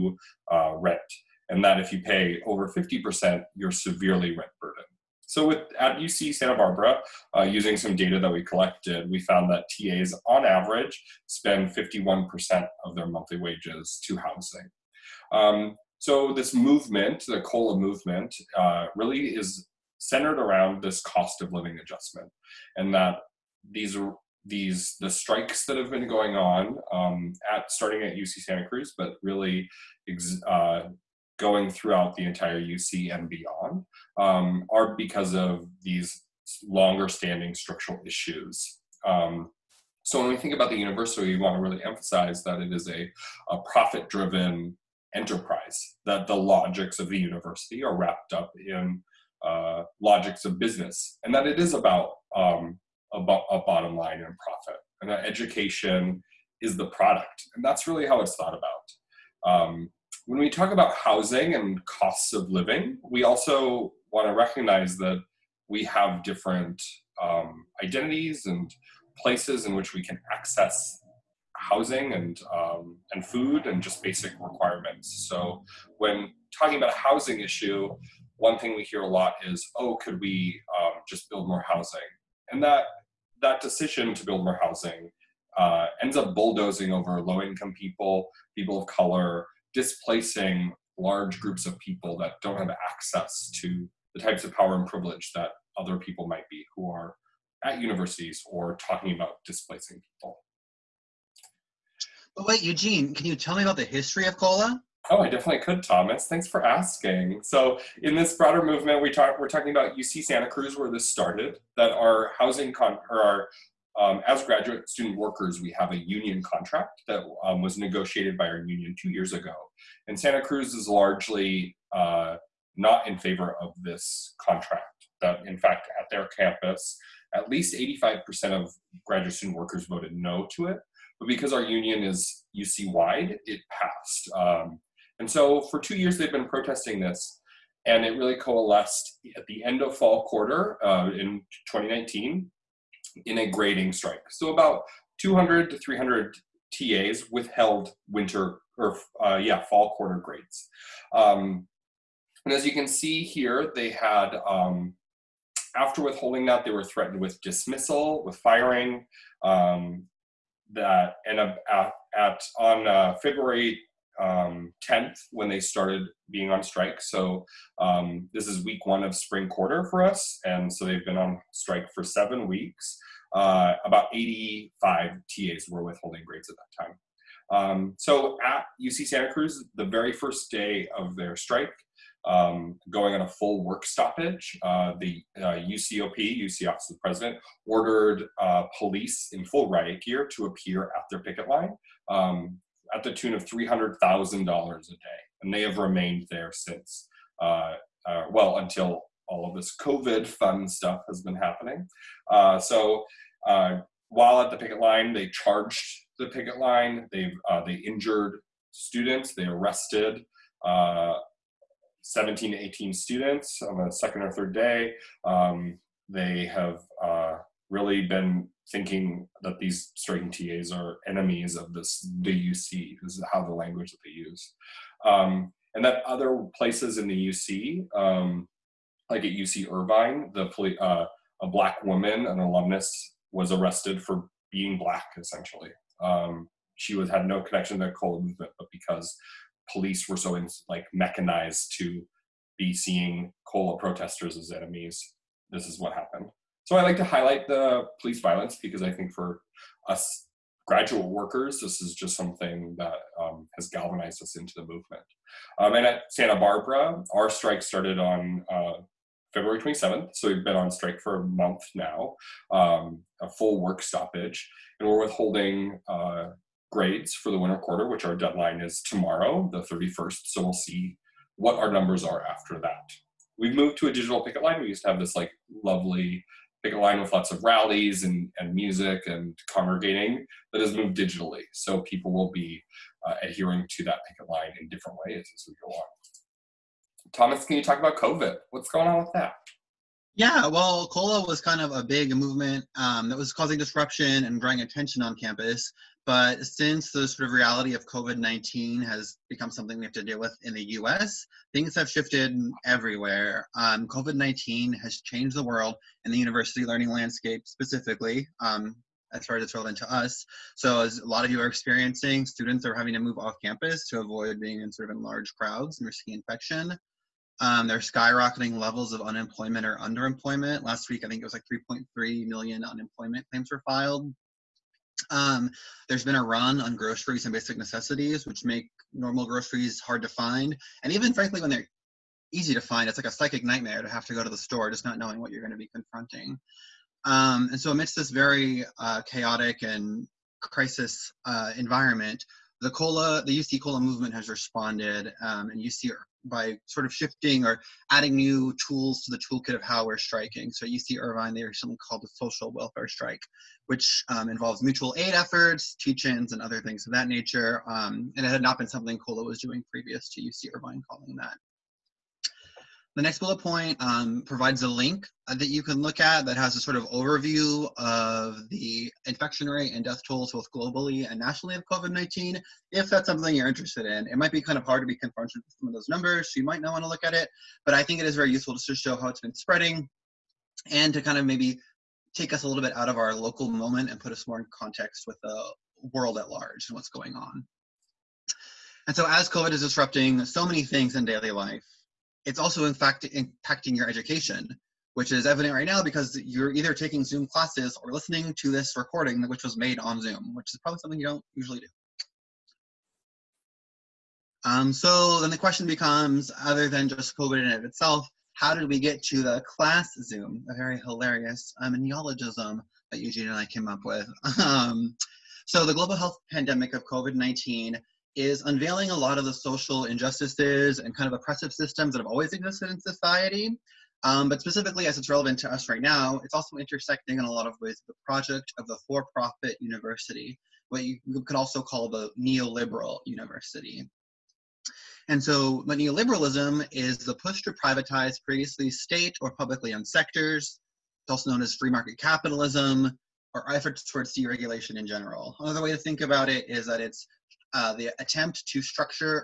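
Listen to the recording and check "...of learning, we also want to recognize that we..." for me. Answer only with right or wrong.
wrong.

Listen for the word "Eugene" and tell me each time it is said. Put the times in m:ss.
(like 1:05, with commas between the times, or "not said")
1:42, 6:52.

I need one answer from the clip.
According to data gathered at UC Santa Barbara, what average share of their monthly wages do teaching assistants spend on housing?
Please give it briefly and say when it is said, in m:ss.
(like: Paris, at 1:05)
51%, at 0:11.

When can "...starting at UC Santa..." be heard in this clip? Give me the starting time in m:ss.
0:27.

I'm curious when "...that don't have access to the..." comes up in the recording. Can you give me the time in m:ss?
1:32.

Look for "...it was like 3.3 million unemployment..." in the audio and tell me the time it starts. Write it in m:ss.
5:21.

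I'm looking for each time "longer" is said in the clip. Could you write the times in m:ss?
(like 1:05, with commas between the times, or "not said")
0:36.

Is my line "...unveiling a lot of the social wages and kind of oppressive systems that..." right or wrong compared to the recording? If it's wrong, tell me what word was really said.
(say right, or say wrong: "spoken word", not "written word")
wrong: "injustices", not "wages".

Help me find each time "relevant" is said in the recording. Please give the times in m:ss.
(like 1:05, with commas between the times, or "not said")
5:09, 7:05.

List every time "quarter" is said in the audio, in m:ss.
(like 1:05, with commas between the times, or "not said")
2:20, 2:29, 2:49, 4:27.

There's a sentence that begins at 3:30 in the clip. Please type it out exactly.
Uh, 17 to 18 students on the second or third day.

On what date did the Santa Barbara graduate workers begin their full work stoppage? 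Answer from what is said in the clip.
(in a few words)
February 27th.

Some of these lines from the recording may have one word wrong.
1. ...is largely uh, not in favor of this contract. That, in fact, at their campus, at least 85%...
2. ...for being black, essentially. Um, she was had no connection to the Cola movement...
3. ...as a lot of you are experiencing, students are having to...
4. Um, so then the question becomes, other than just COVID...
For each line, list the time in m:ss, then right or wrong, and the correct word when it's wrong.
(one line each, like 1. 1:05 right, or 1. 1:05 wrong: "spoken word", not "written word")
1. 2:00 right
2. 3:54 right
3. 5:10 right
4. 6:44 right.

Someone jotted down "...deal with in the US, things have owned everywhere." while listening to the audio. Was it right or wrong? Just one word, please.
wrong.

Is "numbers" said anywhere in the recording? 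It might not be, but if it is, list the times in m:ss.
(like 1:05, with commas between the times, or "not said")
4:31, 6:15.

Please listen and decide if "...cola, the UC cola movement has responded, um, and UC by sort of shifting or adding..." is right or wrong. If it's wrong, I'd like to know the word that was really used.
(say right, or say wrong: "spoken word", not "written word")
right.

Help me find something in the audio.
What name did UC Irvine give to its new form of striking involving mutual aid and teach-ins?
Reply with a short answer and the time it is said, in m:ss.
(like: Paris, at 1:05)
social welfare strike, at 5:52.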